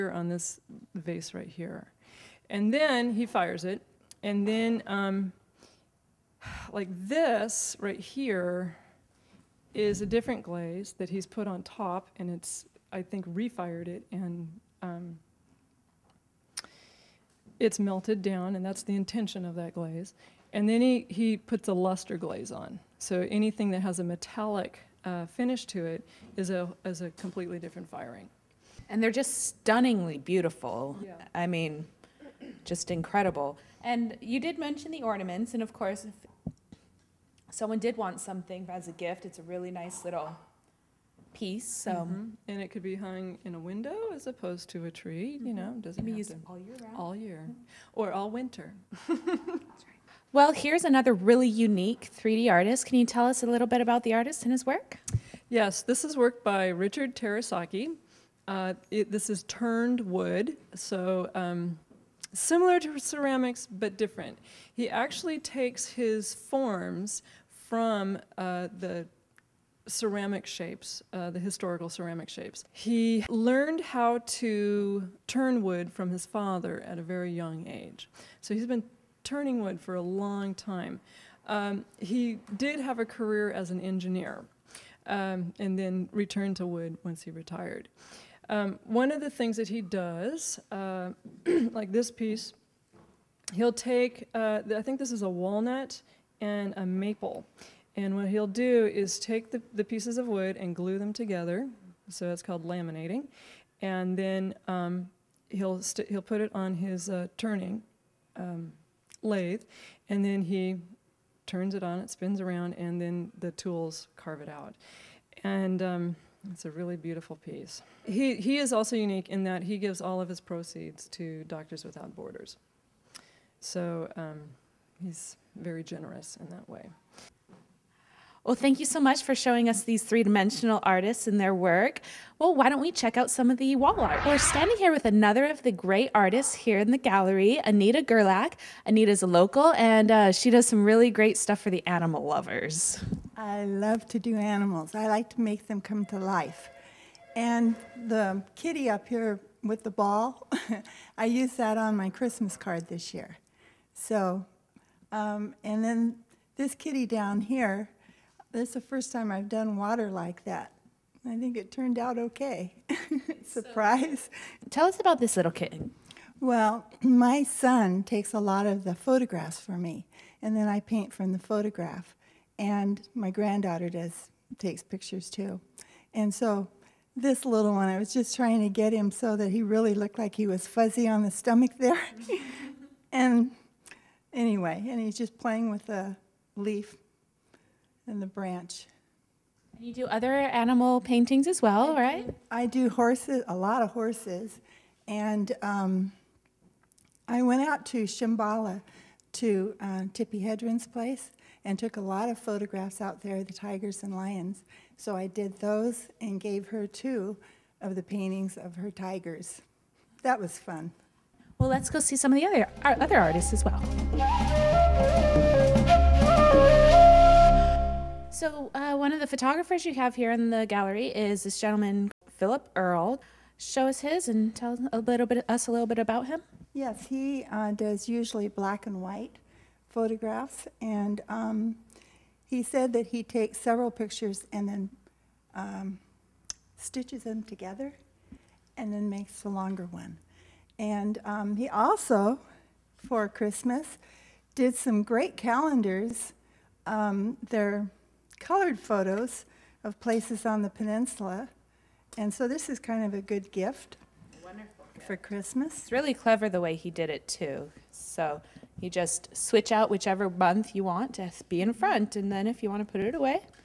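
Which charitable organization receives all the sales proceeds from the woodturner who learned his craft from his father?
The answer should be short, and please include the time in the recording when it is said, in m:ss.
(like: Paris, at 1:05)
Doctors Without Borders, at 2:01.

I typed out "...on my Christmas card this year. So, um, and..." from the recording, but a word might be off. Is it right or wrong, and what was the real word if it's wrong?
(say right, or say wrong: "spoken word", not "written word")
right.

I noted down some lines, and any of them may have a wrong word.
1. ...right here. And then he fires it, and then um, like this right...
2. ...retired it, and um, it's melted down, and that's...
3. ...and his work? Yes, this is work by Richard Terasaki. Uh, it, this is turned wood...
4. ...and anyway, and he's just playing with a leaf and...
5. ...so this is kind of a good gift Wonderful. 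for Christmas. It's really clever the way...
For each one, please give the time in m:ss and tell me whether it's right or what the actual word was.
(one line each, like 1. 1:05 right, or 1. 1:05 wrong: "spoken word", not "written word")
1. 0:01 right
2. 0:13 wrong: "refired", not "retired"
3. 0:54 right
4. 3:03 right
5. 4:12 right.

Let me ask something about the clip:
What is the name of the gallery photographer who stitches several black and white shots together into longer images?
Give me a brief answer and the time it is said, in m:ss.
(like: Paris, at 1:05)
Philip Earle, at 3:42.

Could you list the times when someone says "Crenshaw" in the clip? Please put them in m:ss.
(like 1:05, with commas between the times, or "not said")
not said.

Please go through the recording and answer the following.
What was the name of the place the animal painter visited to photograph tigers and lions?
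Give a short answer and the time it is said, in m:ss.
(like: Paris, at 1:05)
Shambala, at 3:18.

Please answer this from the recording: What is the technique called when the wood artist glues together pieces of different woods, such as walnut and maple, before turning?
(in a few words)
Laminating.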